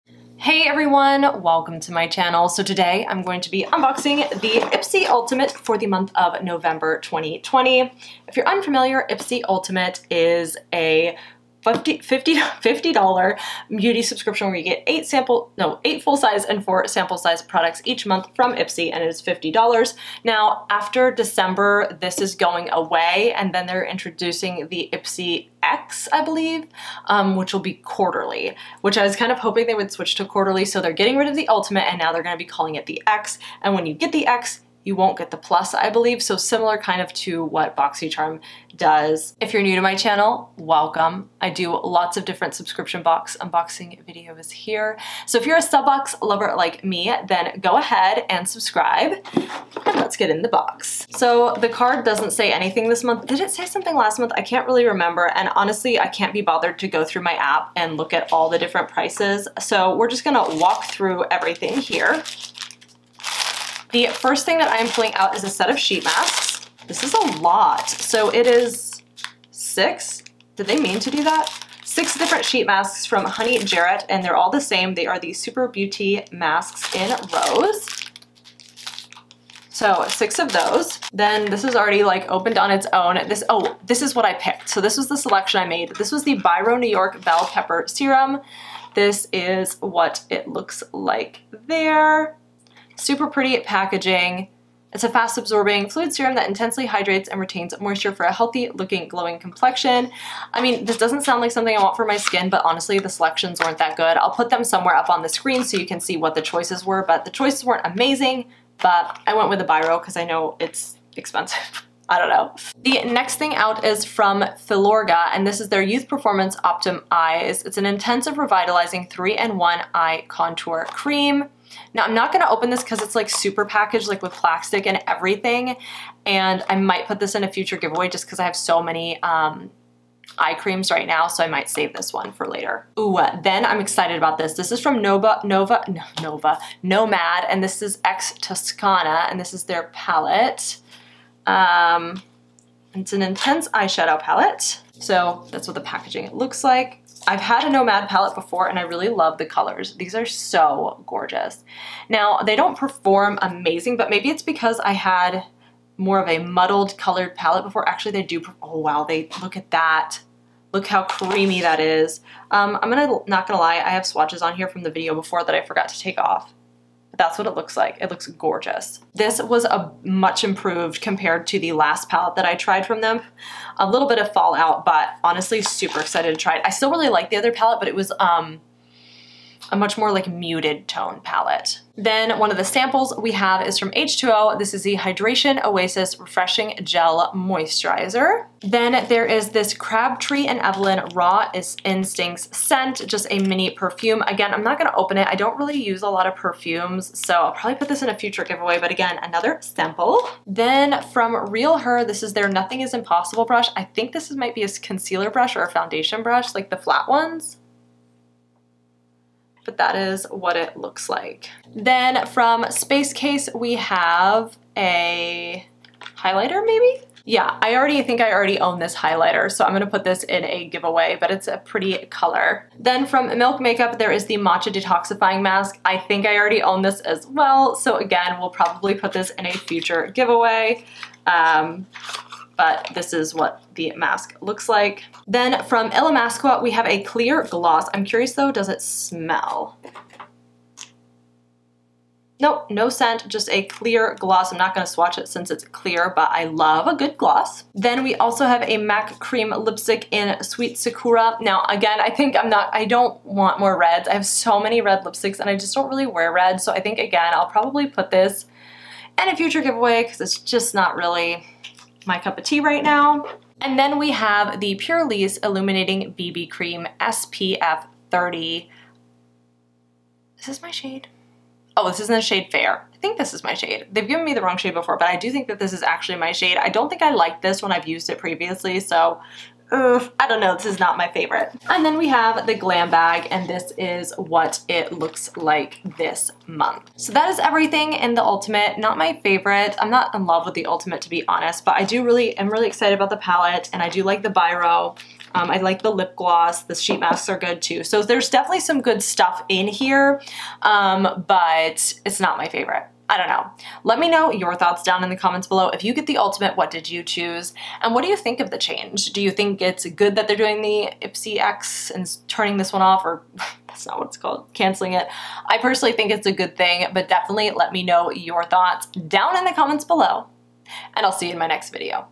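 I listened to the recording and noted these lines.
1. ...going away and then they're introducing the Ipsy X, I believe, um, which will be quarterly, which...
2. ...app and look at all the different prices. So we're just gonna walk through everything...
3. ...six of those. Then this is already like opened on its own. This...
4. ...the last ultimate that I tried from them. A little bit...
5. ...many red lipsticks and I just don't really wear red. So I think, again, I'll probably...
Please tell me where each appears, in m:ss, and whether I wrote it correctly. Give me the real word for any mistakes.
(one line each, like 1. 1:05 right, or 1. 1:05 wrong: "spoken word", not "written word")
1. 0:22 right
2. 0:57 right
3. 1:20 right
4. 2:51 wrong: "palette", not "ultimate"
5. 4:14 right.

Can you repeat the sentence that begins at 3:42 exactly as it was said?
Then from Milk Makeup, there is the Matcha Detoxifying Mask.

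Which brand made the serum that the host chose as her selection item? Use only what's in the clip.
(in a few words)
Biro New York.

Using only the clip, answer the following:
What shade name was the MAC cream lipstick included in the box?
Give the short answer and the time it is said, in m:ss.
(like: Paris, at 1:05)
Sweet Sakura, at 4:10.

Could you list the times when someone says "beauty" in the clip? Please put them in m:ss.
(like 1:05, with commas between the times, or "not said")
0:13, 1:15.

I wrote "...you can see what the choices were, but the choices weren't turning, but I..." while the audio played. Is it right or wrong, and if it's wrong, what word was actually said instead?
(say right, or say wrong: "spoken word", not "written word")
wrong: "amazing", not "turning".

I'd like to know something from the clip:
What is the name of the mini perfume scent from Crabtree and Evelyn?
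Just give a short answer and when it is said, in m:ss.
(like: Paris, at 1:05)
Raw Instincts, at 3:11.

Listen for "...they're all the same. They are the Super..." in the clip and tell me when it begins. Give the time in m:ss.
1:14.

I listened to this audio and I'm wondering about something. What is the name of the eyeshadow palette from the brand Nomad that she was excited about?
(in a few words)
X Toscana.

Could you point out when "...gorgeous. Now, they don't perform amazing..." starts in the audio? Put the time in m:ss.
2:31.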